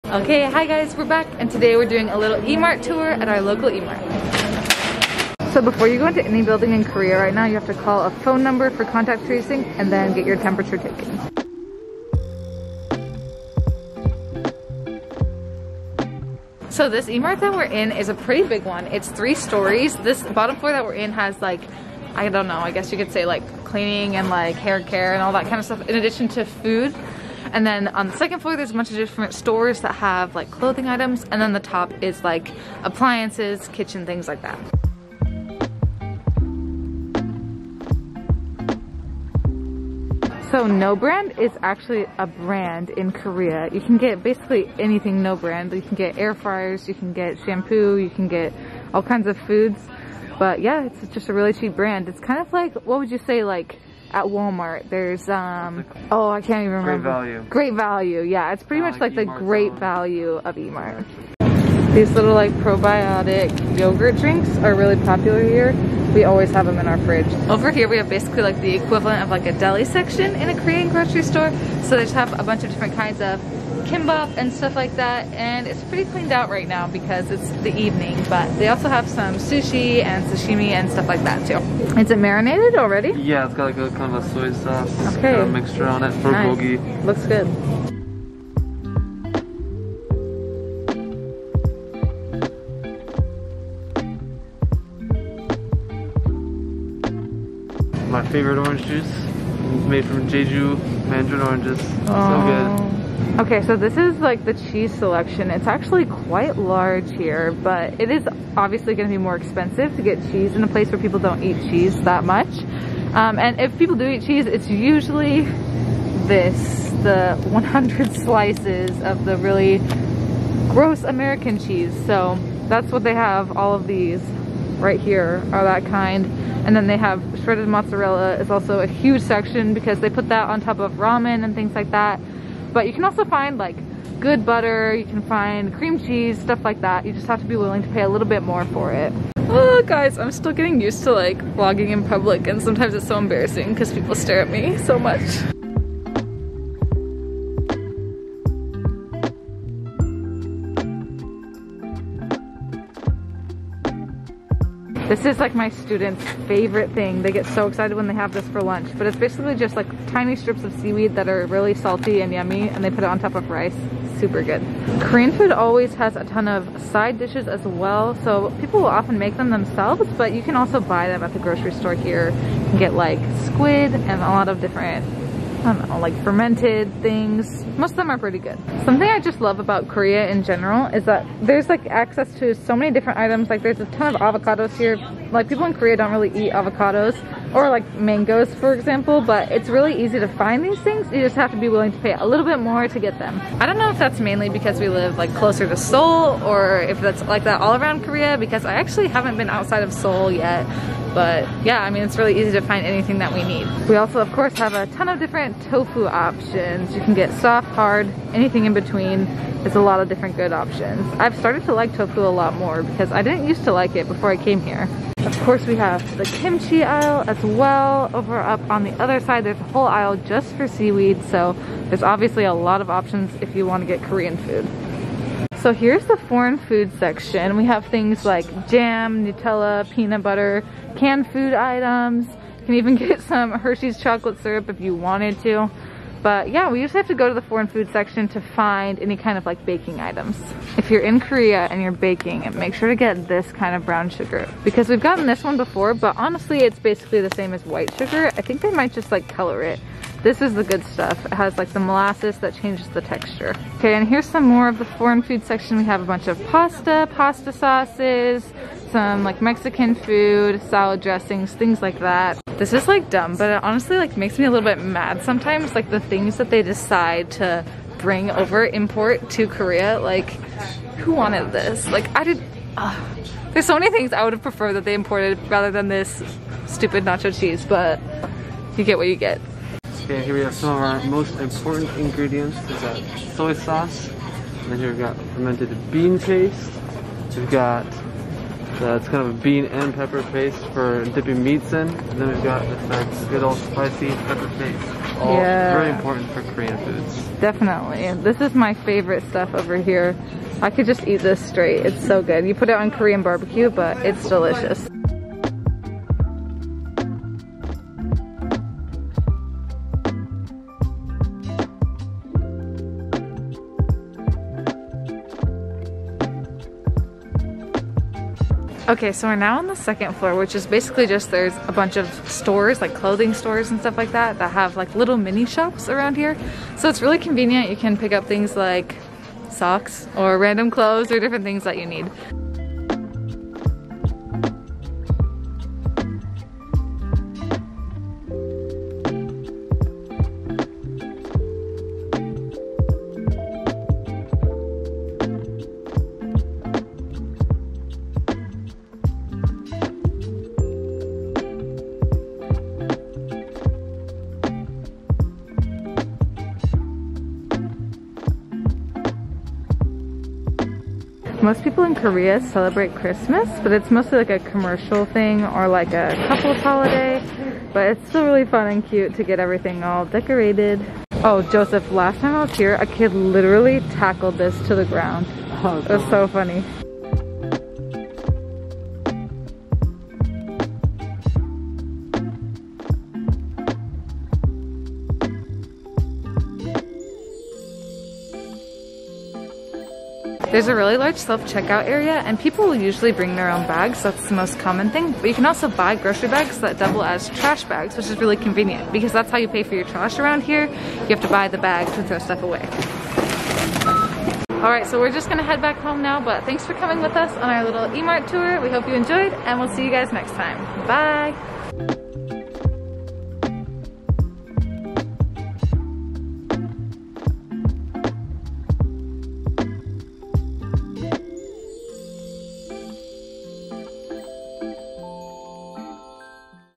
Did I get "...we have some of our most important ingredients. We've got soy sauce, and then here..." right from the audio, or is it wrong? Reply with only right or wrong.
right.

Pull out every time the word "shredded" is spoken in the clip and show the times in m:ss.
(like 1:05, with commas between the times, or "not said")
2:07.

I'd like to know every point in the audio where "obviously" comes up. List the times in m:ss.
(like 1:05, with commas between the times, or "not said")
1:48, 3:42.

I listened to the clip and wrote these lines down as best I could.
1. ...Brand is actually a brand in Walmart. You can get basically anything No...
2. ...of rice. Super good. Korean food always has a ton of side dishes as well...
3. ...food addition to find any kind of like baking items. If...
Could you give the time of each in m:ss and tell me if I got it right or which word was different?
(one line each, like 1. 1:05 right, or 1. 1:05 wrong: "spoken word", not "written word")
1. 0:40 wrong: "Korea", not "Walmart"
2. 2:43 right
3. 3:57 wrong: "section", not "addition".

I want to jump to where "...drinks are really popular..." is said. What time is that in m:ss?
1:04.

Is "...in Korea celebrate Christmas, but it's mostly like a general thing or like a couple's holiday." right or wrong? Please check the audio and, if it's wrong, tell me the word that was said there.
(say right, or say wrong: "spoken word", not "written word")
wrong: "commercial", not "general".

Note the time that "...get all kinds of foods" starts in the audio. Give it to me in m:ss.
0:48.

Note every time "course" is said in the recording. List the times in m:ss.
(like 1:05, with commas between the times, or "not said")
3:24, 3:35.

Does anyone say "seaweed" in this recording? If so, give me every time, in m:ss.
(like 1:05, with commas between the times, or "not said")
2:40, 3:40.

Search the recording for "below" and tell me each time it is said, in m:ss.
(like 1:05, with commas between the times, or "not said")
not said.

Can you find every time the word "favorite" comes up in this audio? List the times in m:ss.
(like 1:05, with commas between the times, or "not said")
1:38, 2:36, 4:58.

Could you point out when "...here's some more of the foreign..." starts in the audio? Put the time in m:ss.
4:14.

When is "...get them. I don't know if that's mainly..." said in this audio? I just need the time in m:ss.
3:12.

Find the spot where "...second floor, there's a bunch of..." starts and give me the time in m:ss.
0:28.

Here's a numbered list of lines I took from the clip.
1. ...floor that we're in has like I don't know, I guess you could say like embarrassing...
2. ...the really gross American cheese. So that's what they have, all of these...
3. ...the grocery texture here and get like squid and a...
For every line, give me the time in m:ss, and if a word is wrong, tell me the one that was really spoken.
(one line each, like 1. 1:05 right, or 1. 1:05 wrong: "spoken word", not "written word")
1. 0:20 wrong: "cleaning", not "embarrassing"
2. 1:59 right
3. 2:51 wrong: "store", not "texture".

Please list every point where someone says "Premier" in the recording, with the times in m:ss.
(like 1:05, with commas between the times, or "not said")
not said.